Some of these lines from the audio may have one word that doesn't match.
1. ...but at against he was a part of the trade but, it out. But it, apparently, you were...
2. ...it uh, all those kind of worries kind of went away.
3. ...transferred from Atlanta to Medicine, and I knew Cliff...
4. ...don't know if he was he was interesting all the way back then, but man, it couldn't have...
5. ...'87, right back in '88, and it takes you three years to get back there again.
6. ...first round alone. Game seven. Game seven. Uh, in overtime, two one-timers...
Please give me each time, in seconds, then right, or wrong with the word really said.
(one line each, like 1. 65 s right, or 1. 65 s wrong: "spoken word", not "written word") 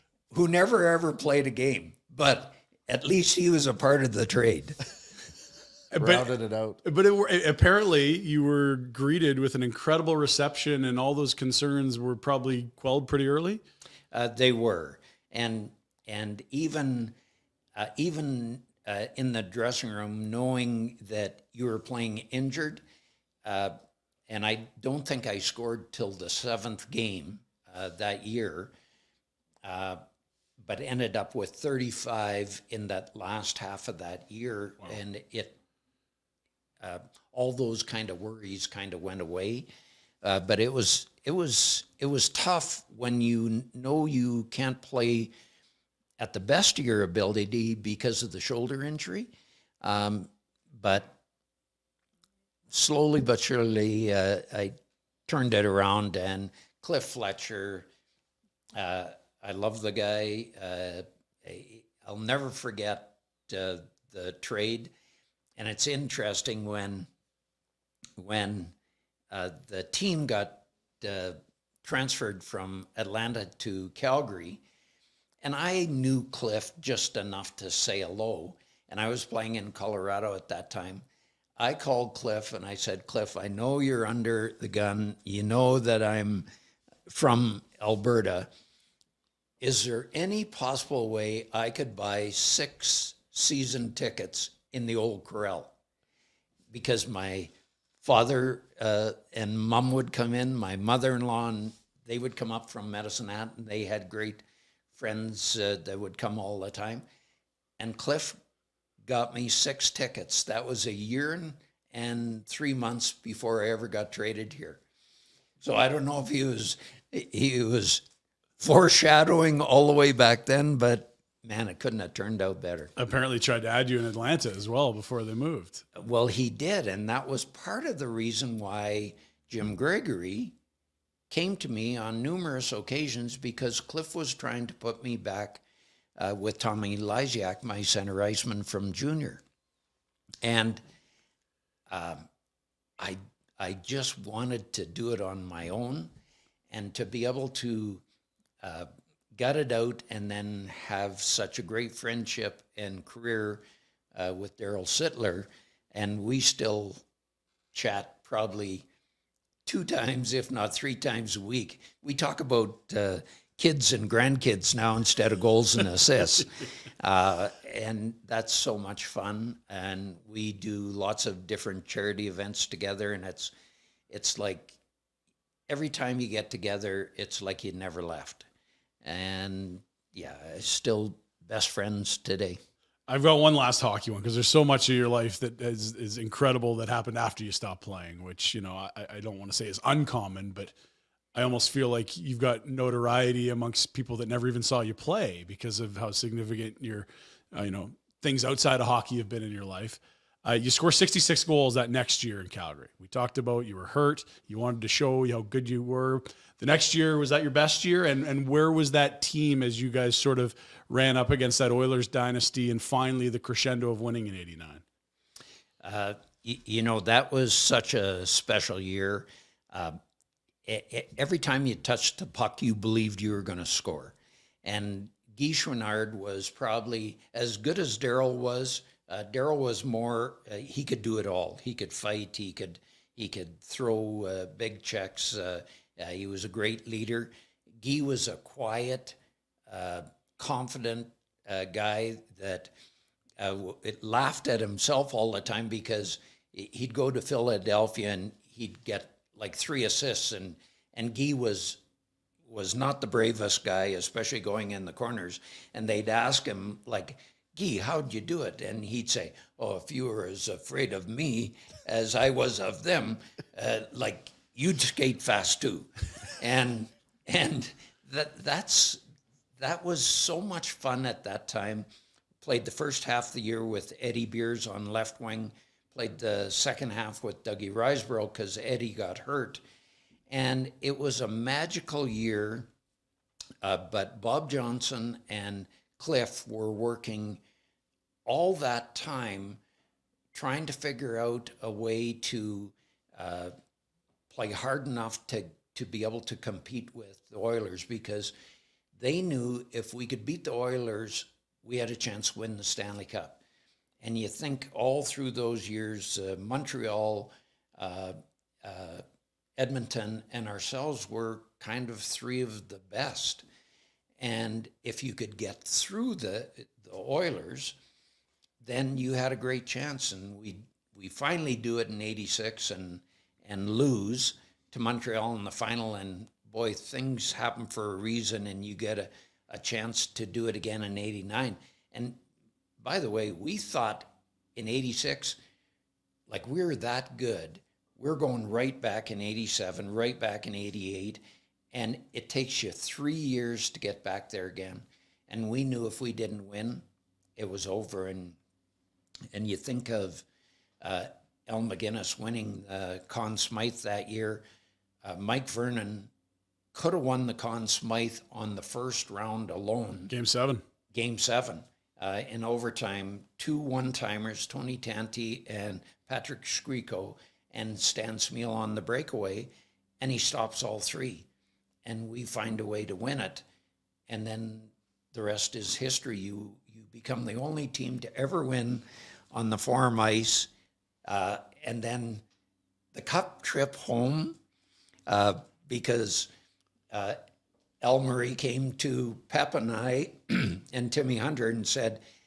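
1. 2 s wrong: "least", not "against"
2. 35 s right
3. 71 s wrong: "Calgary", not "Medicine"
4. 115 s wrong: "foreshadowing", not "interesting"
5. 339 s right
6. 358 s right.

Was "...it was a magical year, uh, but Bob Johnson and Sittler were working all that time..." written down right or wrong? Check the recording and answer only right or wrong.
wrong.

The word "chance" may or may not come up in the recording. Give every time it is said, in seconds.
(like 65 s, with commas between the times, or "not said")
301 s, 319 s, 329 s.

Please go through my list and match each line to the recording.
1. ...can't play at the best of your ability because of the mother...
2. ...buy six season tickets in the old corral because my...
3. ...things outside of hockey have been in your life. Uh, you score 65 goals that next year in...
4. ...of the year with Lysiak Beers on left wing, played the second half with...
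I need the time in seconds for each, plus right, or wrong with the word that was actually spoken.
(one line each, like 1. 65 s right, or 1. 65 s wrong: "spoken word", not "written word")
1. 44 s wrong: "shoulder", not "mother"
2. 91 s right
3. 198 s wrong: "66", not "65"
4. 273 s wrong: "Eddie", not "Lysiak".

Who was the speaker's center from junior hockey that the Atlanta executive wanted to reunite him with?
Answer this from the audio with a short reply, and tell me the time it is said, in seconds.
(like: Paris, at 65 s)
Tommy Lysiak, at 136 s.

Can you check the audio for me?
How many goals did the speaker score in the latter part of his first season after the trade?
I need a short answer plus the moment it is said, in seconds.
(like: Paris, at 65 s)
35, at 31 s.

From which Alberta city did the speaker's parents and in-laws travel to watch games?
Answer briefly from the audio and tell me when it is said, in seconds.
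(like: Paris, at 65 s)
Medicine Hat, at 102 s.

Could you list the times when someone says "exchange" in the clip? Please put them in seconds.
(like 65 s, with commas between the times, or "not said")
not said.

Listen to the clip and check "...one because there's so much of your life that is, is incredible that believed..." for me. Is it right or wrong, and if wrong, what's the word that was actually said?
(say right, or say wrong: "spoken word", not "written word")
wrong: "happened", not "believed".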